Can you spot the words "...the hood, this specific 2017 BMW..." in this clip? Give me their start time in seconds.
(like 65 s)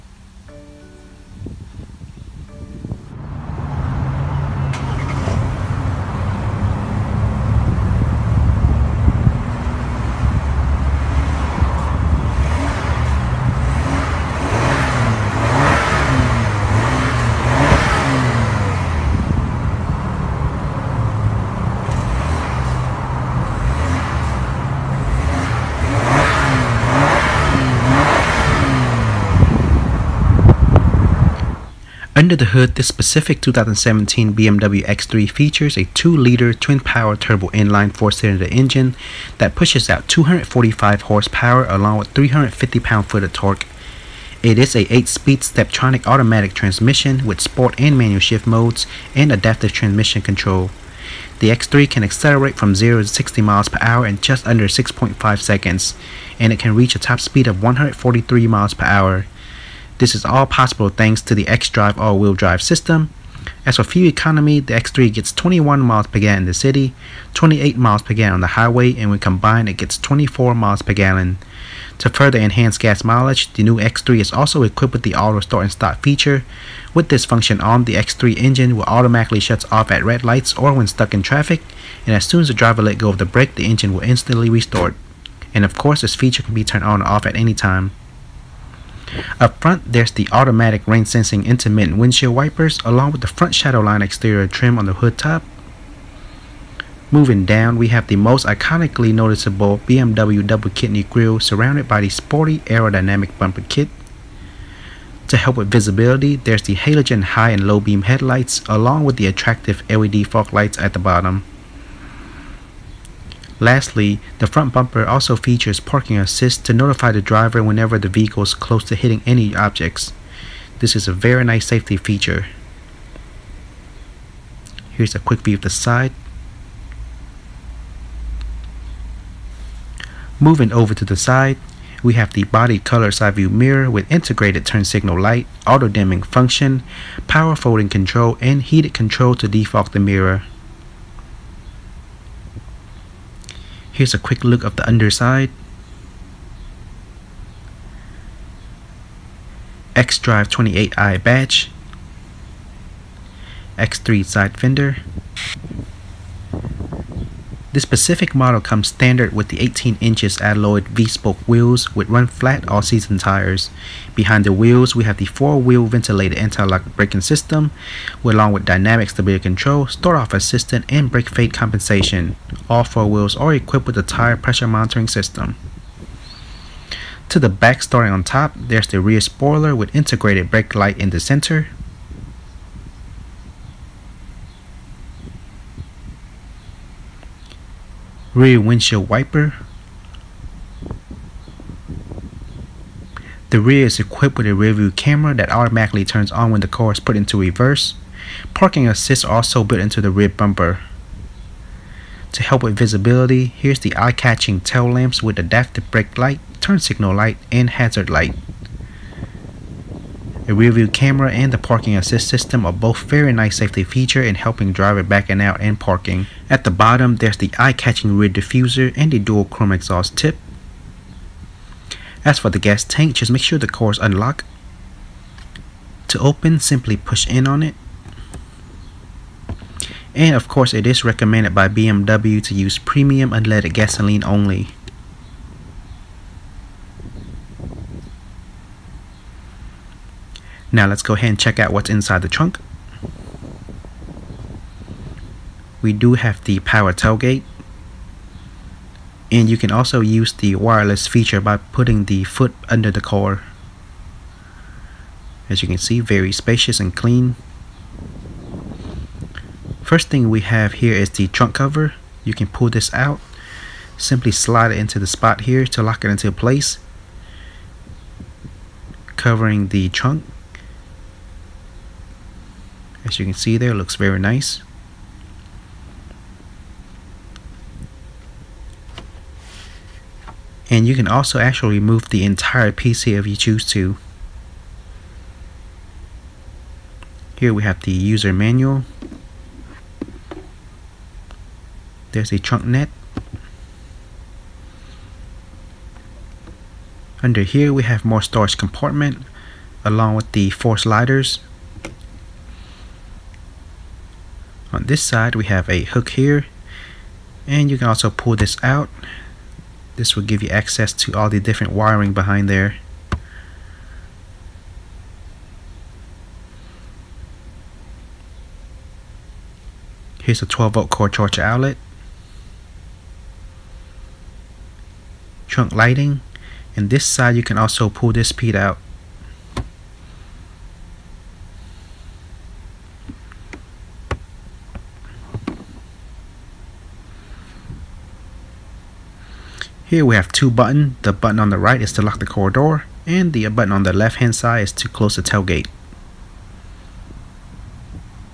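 32 s.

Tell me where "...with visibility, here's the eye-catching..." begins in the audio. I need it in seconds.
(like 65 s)
202 s.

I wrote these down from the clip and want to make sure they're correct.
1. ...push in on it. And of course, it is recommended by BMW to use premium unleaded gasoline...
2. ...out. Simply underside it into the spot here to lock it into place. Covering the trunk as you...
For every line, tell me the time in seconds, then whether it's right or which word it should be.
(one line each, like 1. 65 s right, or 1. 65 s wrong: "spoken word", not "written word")
1. 226 s right
2. 262 s wrong: "slide", not "underside".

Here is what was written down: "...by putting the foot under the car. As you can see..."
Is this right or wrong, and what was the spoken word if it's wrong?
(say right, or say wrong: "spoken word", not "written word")
right.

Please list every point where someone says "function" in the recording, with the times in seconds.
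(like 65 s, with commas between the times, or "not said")
77 s, 136 s.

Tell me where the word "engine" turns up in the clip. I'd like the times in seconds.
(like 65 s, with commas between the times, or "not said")
38 s, 78 s, 83 s.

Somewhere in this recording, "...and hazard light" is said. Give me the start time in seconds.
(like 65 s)
207 s.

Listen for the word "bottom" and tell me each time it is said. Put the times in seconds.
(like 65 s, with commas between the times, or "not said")
110 s, 216 s.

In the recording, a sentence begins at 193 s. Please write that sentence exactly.
The rear is equipped with a rearview camera that automatically turns on when the car is put into reverse.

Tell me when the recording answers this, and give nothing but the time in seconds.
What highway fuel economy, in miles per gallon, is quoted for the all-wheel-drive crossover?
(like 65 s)
67 s.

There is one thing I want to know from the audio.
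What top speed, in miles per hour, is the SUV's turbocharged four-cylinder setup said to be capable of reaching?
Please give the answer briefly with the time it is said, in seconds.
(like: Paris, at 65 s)
143, at 57 s.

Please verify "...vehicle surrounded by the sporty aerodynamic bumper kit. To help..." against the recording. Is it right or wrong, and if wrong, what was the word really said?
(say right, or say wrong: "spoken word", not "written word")
wrong: "grille", not "vehicle".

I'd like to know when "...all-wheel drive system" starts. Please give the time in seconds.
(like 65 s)
61 s.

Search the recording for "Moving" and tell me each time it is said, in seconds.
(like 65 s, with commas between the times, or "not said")
97 s, 130 s.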